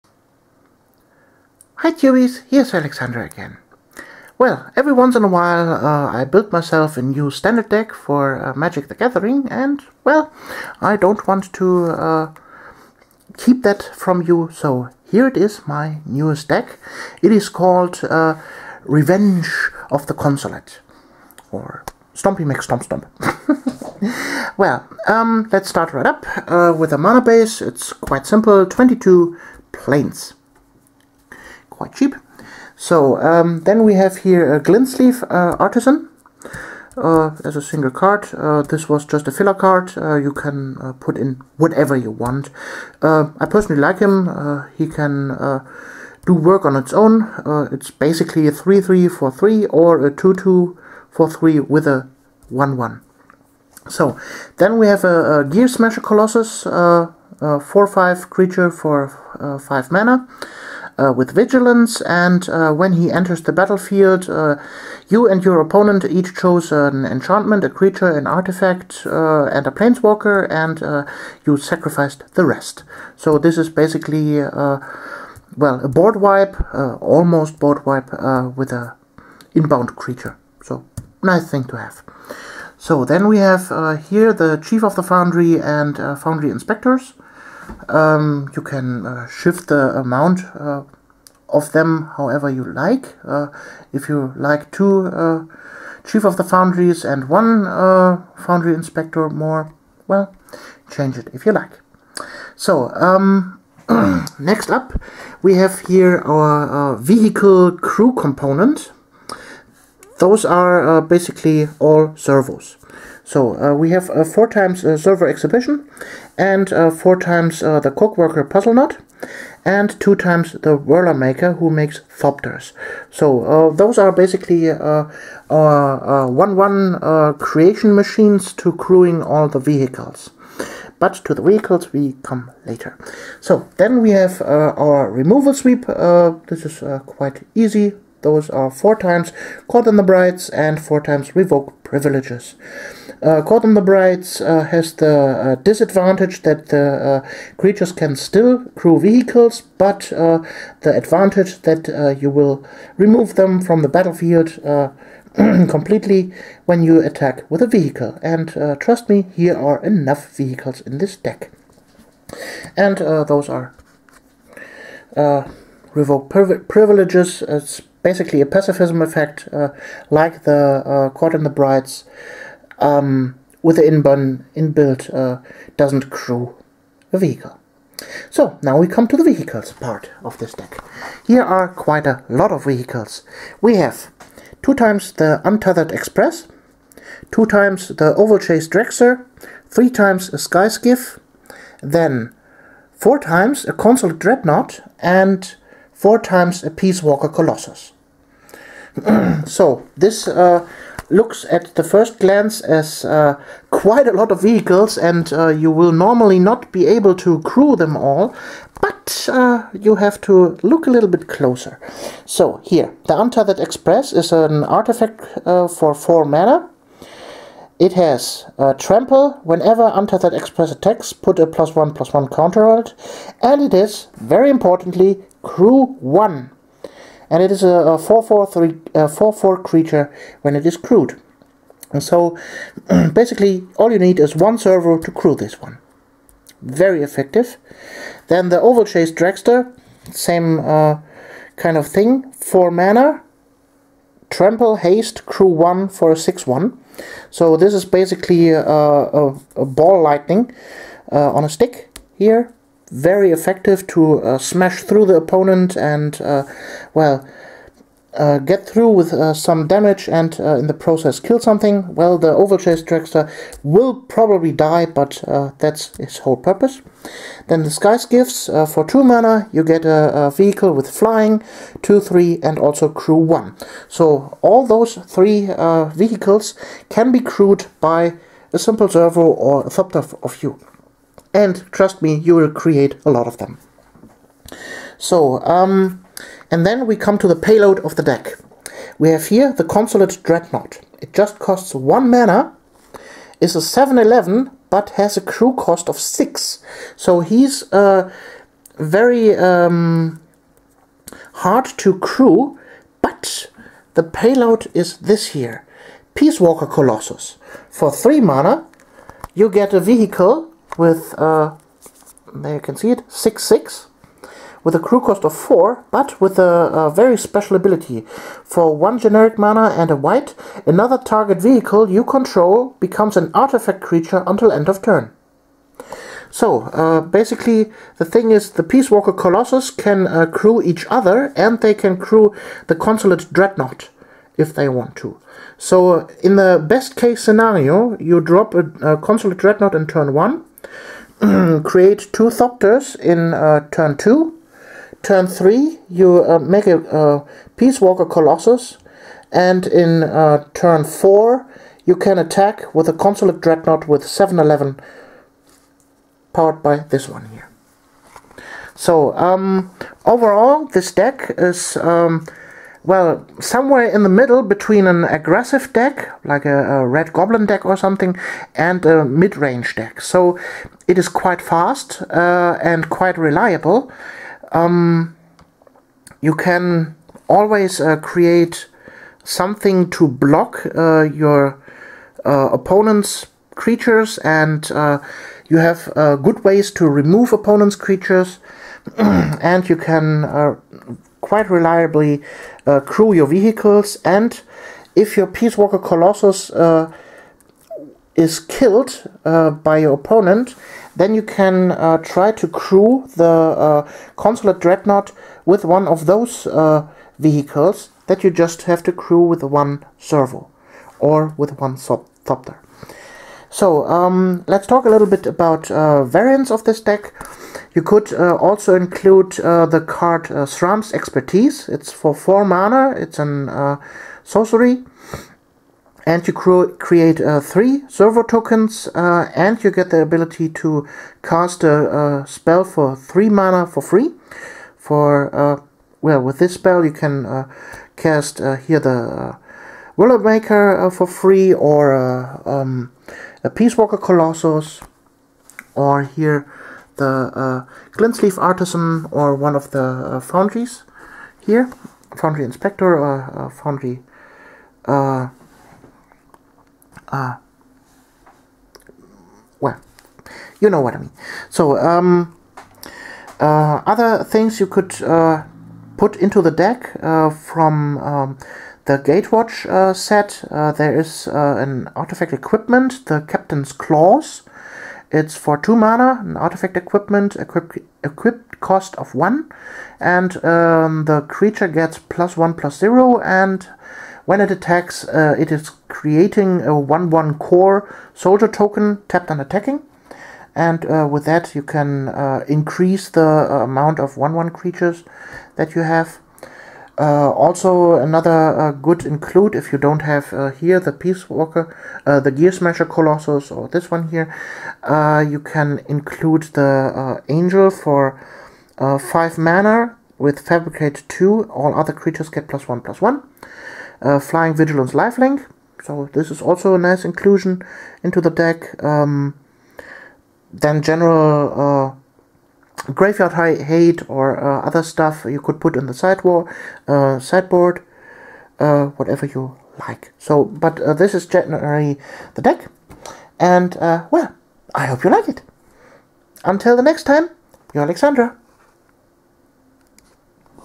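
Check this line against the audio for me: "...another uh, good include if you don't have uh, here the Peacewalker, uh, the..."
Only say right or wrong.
right.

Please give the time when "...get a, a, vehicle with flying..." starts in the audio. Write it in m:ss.
4:29.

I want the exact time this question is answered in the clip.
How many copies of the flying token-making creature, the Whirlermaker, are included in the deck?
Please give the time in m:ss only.
1:59.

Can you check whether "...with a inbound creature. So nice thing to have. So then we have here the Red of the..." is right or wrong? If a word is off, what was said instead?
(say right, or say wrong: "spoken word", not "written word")
wrong: "Chief", not "Red".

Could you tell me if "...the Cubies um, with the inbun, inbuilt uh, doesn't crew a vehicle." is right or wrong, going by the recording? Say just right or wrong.
wrong.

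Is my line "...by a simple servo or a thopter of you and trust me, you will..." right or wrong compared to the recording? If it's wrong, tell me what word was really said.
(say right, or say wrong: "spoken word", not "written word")
right.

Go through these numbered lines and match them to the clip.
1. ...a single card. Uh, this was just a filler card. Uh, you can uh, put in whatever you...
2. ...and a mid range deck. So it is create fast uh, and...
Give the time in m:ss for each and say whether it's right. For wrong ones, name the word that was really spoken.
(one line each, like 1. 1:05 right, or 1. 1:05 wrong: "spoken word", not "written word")
1. 0:37 right
2. 6:08 wrong: "quite", not "create".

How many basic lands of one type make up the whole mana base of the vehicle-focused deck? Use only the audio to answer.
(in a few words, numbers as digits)
22.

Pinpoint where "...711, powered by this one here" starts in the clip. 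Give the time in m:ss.
5:54.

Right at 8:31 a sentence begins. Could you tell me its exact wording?
All other creatures get plus 1 plus 1.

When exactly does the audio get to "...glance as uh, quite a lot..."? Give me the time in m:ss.
3:22.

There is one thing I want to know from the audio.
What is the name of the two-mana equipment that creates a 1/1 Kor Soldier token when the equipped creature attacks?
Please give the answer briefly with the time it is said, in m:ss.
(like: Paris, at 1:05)
Captain's Claws, at 7:53.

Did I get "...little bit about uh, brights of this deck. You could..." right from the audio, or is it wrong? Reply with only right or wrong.
wrong.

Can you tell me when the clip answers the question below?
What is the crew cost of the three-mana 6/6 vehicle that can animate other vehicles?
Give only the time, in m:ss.
5:14.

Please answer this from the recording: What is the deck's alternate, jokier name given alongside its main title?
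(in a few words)
Stompy Mix Stomp Stomp.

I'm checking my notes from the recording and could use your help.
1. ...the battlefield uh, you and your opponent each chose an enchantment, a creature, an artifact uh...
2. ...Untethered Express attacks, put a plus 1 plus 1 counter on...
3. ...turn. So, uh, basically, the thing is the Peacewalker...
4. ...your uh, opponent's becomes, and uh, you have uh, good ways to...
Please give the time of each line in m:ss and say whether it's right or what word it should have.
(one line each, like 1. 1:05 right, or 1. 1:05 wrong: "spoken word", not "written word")
1. 1:03 right
2. 3:39 right
3. 5:24 right
4. 6:21 wrong: "creatures", not "becomes".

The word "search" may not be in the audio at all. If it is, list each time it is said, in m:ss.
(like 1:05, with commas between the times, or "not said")
not said.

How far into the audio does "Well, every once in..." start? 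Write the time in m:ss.
0:04.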